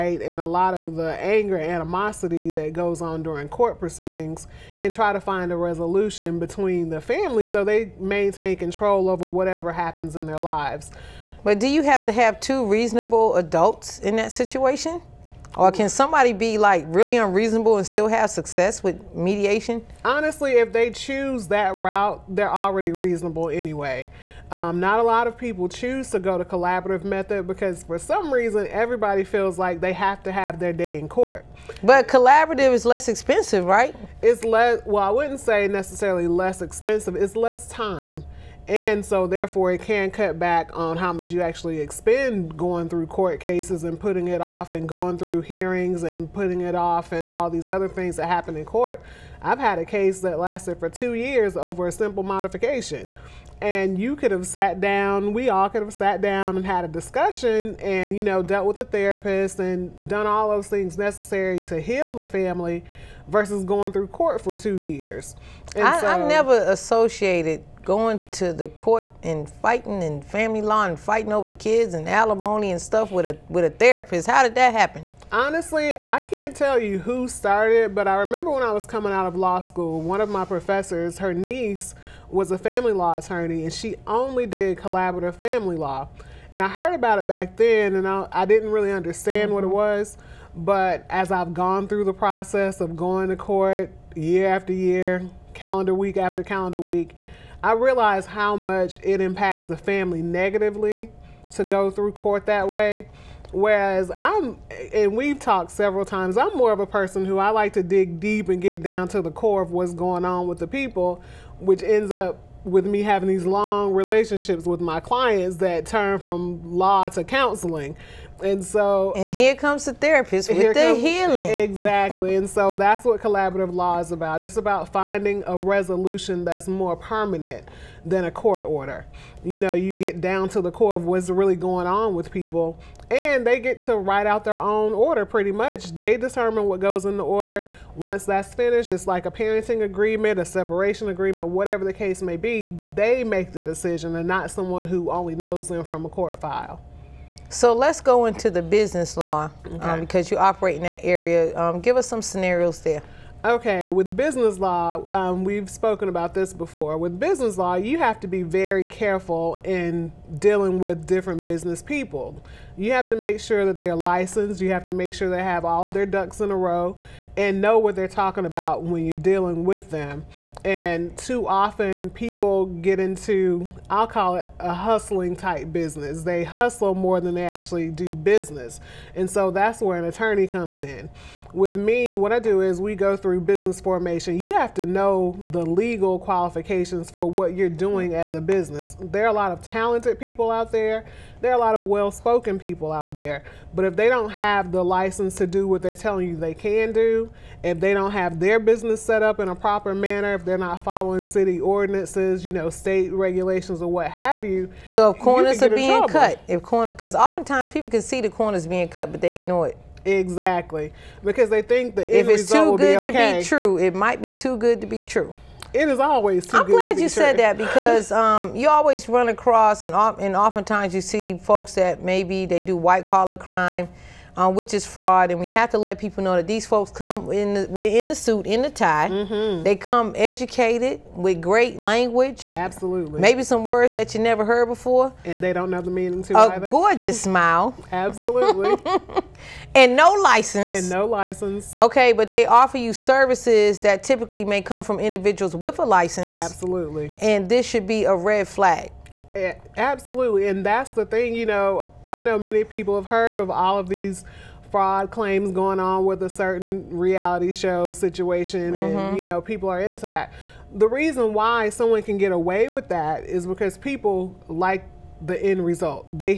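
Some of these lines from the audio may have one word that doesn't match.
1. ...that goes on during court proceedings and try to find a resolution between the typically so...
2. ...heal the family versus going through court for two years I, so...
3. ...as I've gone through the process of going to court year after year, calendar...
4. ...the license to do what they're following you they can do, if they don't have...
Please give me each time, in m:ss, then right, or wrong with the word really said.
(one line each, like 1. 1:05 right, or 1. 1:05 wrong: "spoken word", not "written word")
1. 0:02 wrong: "family", not "typically"
2. 1:01 right
3. 1:31 right
4. 3:14 wrong: "telling", not "following".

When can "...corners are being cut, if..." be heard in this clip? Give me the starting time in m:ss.
3:25.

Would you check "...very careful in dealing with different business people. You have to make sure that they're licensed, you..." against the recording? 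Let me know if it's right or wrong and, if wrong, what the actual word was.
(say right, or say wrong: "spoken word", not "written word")
right.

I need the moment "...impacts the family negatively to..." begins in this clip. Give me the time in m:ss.
1:39.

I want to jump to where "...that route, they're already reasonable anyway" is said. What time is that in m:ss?
0:21.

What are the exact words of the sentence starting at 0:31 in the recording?
But collaborative is less expensive, right?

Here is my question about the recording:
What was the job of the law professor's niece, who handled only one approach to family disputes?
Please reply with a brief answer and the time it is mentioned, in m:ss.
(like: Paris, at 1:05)
family law attorney, at 1:22.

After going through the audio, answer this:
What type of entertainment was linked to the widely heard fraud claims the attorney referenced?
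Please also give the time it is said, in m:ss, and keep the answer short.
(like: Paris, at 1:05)
reality show, at 4:16.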